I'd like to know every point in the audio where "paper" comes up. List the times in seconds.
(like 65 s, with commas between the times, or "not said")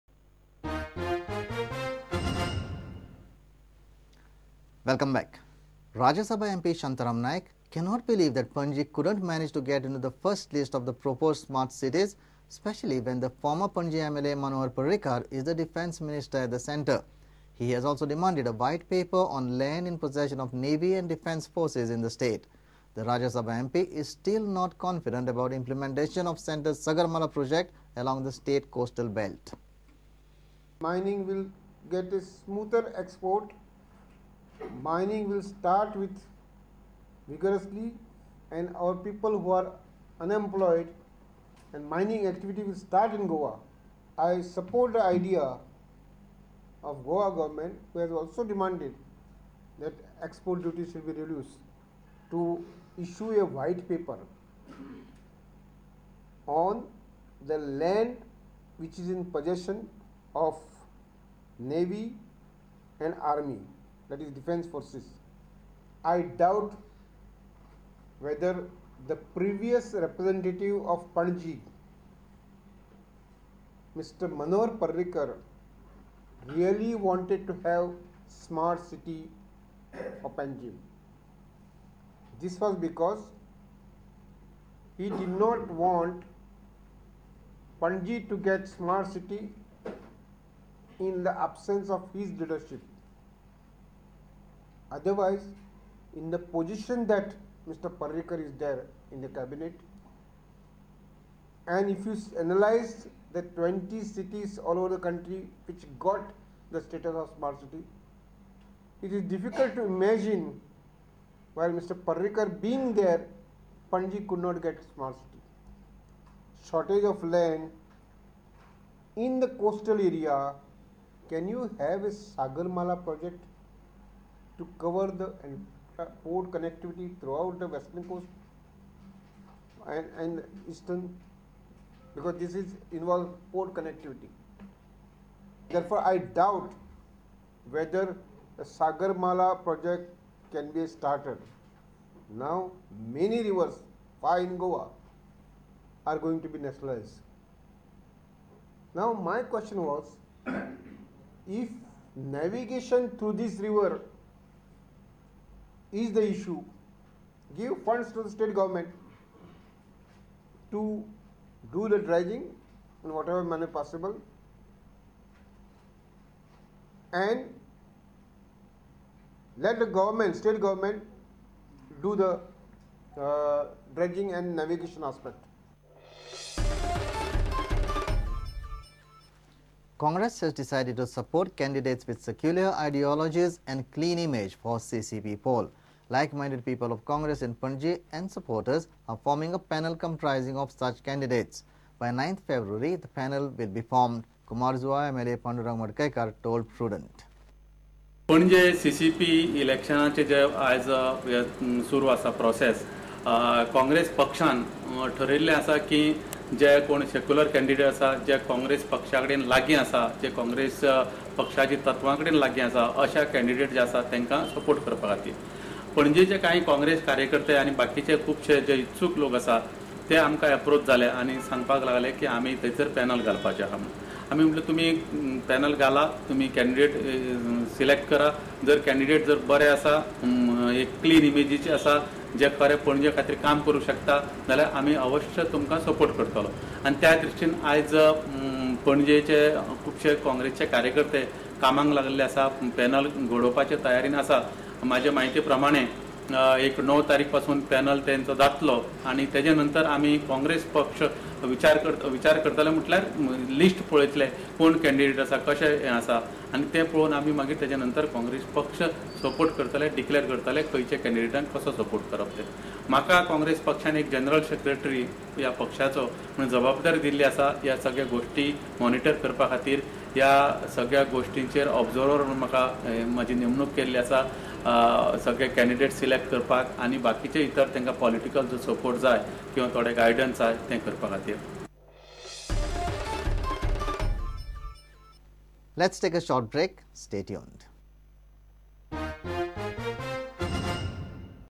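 18 s, 53 s.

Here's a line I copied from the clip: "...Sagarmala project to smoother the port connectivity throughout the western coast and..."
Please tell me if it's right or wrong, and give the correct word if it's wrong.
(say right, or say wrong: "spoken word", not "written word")
wrong: "cover", not "smoother".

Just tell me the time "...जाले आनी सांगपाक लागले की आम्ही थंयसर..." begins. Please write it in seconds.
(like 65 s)
220 s.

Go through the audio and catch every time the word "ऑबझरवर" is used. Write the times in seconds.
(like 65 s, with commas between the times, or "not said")
271 s.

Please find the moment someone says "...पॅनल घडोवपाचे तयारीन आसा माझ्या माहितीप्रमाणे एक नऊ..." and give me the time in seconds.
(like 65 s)
242 s.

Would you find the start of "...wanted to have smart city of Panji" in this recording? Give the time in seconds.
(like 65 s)
77 s.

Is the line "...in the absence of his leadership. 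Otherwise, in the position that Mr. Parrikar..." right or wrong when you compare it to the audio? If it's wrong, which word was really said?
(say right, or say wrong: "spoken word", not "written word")
right.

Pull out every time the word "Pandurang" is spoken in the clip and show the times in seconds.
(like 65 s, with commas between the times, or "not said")
195 s.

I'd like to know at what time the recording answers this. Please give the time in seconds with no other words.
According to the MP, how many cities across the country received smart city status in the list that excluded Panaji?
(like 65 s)
103 s.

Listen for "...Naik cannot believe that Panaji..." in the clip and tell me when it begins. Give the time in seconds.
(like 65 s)
7 s.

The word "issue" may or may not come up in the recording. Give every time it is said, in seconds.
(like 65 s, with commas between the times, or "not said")
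53 s, 156 s.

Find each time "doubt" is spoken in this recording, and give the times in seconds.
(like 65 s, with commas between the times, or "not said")
66 s, 136 s.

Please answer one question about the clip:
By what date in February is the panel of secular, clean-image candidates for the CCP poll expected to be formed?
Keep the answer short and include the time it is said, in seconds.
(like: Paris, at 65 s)
9th February, at 192 s.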